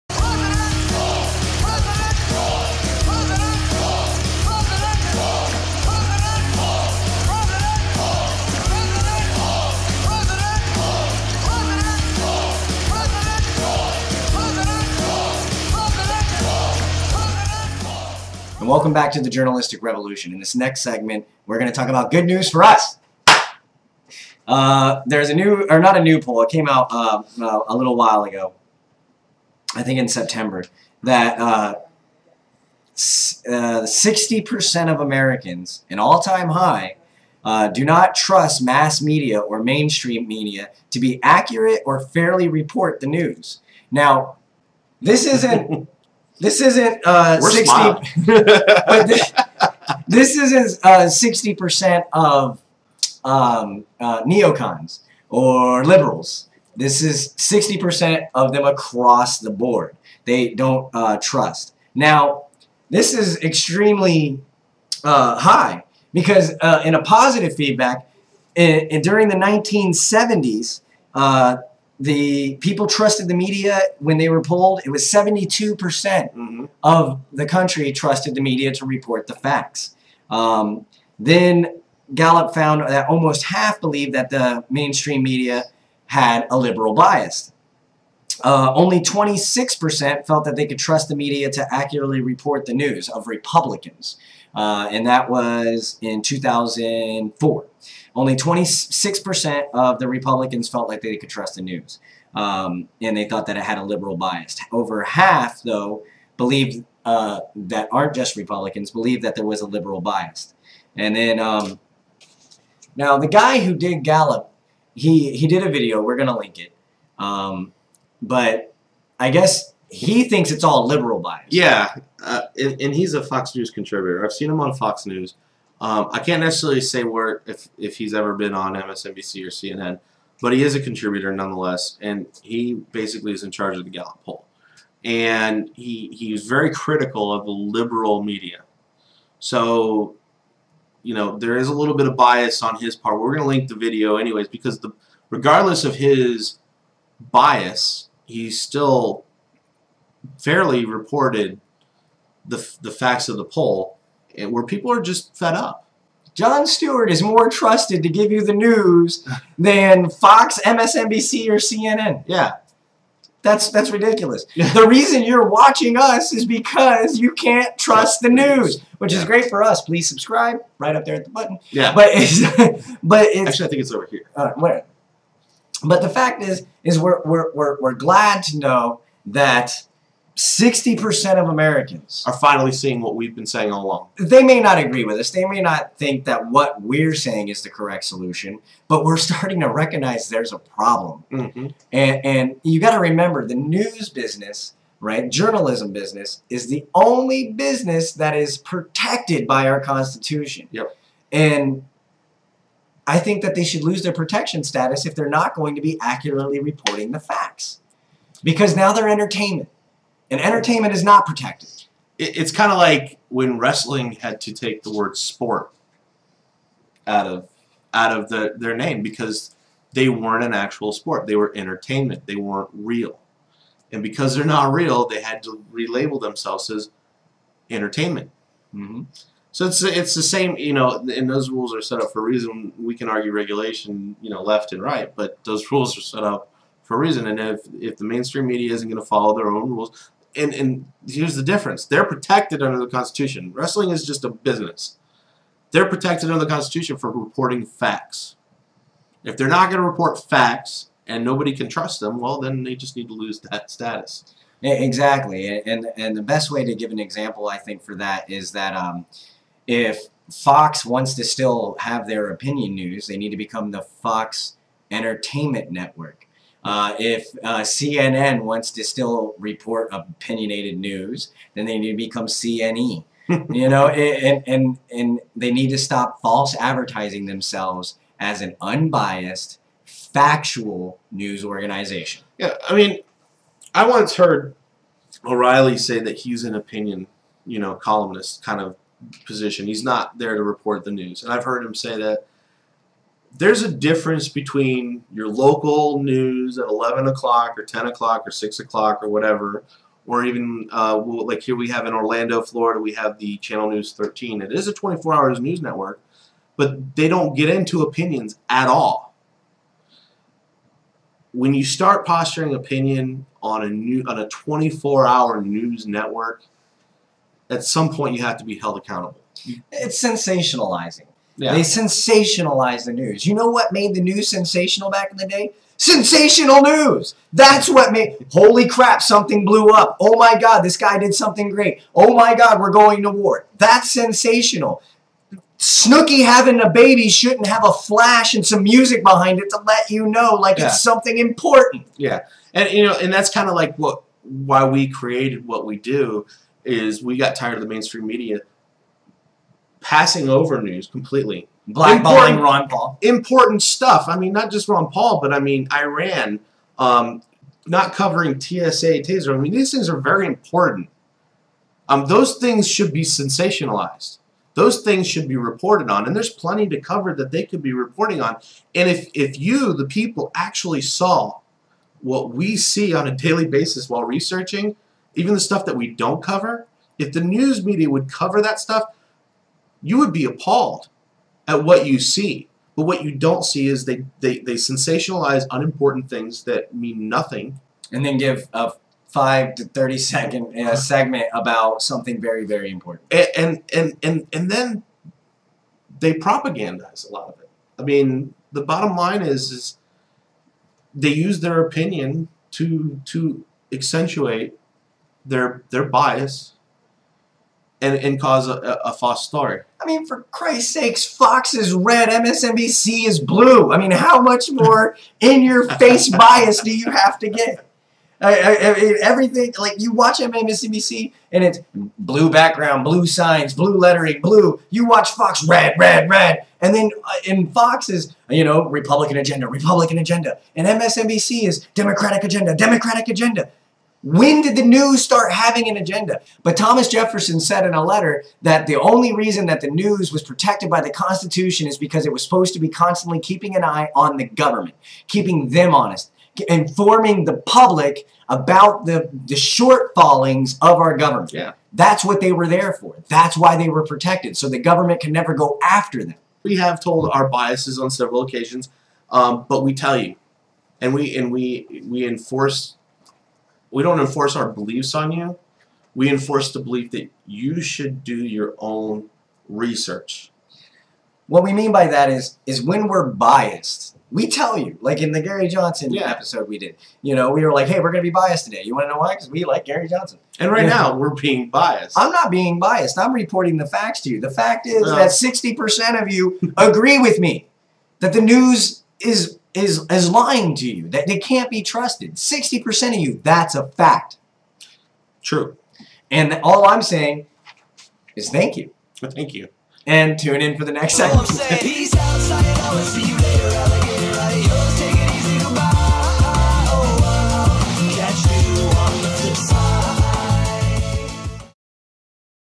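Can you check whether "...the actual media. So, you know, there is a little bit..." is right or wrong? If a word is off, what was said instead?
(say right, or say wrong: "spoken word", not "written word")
wrong: "liberal", not "actual".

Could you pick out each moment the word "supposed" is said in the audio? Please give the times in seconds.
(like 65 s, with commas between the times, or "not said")
442 s.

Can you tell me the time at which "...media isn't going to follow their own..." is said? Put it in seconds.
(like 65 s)
238 s.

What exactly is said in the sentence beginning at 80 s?
Um, then Gallup found that almost half believed that the mainstream media had a liberal bias.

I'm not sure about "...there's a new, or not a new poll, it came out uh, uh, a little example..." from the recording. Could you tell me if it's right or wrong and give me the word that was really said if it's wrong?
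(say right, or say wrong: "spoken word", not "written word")
wrong: "while", not "example".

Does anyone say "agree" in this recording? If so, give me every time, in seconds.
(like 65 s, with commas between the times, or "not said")
184 s, 486 s.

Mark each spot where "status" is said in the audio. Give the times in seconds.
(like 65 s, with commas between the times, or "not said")
204 s, 253 s.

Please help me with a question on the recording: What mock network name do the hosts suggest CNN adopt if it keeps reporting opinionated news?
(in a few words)
CNE.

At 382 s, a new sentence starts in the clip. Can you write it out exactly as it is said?
But what you don't see is they, they, they sensationalize unimportant things that mean nothing.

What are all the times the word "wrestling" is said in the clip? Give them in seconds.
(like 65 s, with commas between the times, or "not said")
213 s, 243 s.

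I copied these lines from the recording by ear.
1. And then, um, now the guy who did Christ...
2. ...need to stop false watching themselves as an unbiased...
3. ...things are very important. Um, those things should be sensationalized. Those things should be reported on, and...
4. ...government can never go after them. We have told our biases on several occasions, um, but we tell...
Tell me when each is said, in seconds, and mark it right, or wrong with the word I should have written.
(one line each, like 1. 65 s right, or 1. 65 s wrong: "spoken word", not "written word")
1. 110 s wrong: "Gallup", not "Christ"
2. 275 s wrong: "advertising", not "watching"
3. 359 s right
4. 454 s right.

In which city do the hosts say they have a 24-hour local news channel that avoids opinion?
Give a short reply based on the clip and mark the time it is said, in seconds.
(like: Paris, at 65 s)
Orlando, Florida, at 301 s.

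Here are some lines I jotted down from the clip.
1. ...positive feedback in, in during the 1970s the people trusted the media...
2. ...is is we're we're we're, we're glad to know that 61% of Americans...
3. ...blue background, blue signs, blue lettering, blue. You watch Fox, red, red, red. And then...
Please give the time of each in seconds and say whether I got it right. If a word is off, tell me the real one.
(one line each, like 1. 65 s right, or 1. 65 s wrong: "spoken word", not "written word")
1. 67 s right
2. 176 s wrong: "60", not "61"
3. 421 s right.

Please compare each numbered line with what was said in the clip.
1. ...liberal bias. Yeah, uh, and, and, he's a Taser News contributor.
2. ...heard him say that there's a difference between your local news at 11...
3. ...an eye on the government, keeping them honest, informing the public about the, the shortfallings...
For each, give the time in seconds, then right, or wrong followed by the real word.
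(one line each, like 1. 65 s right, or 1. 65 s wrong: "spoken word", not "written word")
1. 120 s wrong: "Fox", not "Taser"
2. 291 s right
3. 443 s right.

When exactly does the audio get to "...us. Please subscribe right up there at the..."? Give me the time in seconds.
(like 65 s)
169 s.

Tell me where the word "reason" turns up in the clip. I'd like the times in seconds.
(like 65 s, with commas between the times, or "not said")
164 s, 232 s, 237 s, 439 s.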